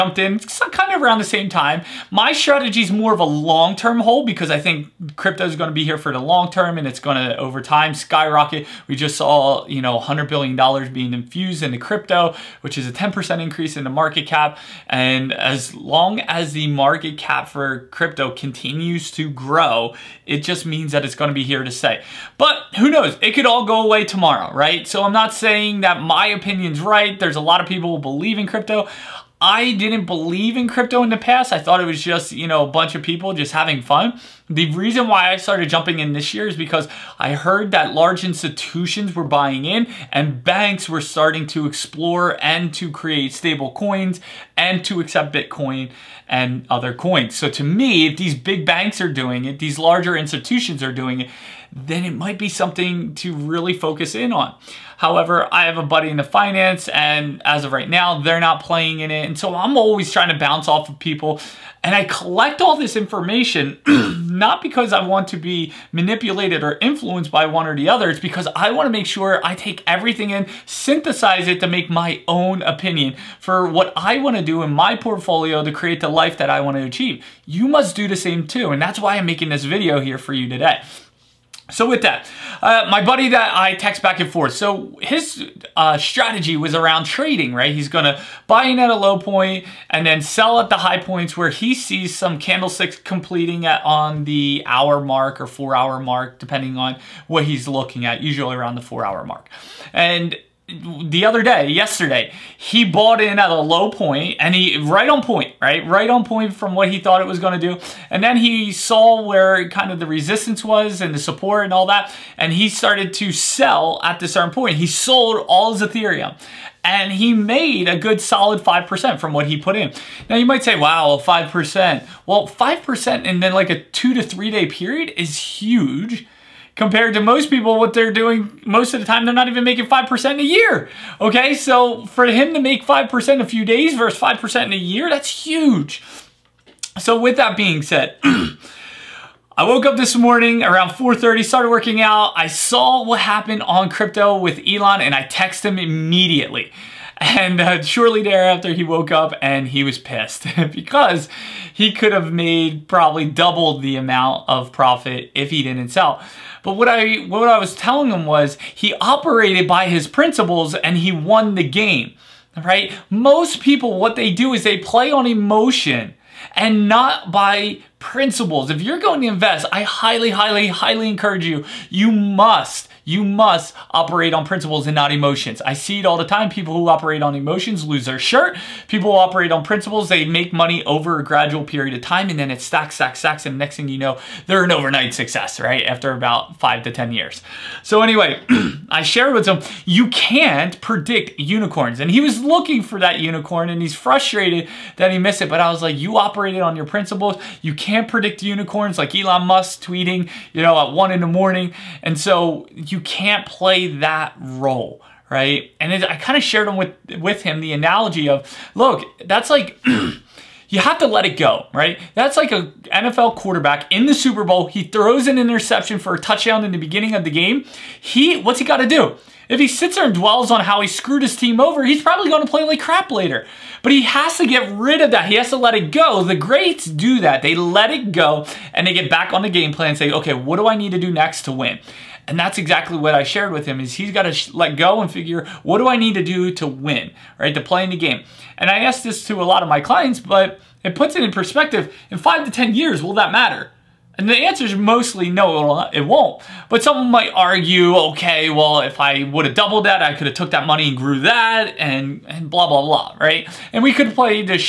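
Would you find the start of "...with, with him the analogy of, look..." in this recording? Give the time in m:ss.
3:26.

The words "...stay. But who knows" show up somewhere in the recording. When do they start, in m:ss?
0:21.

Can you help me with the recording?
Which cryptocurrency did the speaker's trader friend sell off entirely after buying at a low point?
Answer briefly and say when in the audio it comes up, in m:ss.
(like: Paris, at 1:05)
Ethereum, at 1:55.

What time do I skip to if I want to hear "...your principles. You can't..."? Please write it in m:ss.
3:16.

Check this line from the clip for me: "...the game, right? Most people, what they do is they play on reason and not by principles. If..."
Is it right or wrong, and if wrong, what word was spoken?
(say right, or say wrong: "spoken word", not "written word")
wrong: "emotion", not "reason".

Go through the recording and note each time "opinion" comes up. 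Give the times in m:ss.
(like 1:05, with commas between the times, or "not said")
0:26, 1:12.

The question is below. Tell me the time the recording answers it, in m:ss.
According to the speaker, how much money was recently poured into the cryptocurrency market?
0:09.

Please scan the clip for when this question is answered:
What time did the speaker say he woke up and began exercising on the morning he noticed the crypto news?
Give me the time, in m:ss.
2:20.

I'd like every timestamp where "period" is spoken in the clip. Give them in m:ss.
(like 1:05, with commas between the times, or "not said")
2:04, 3:01.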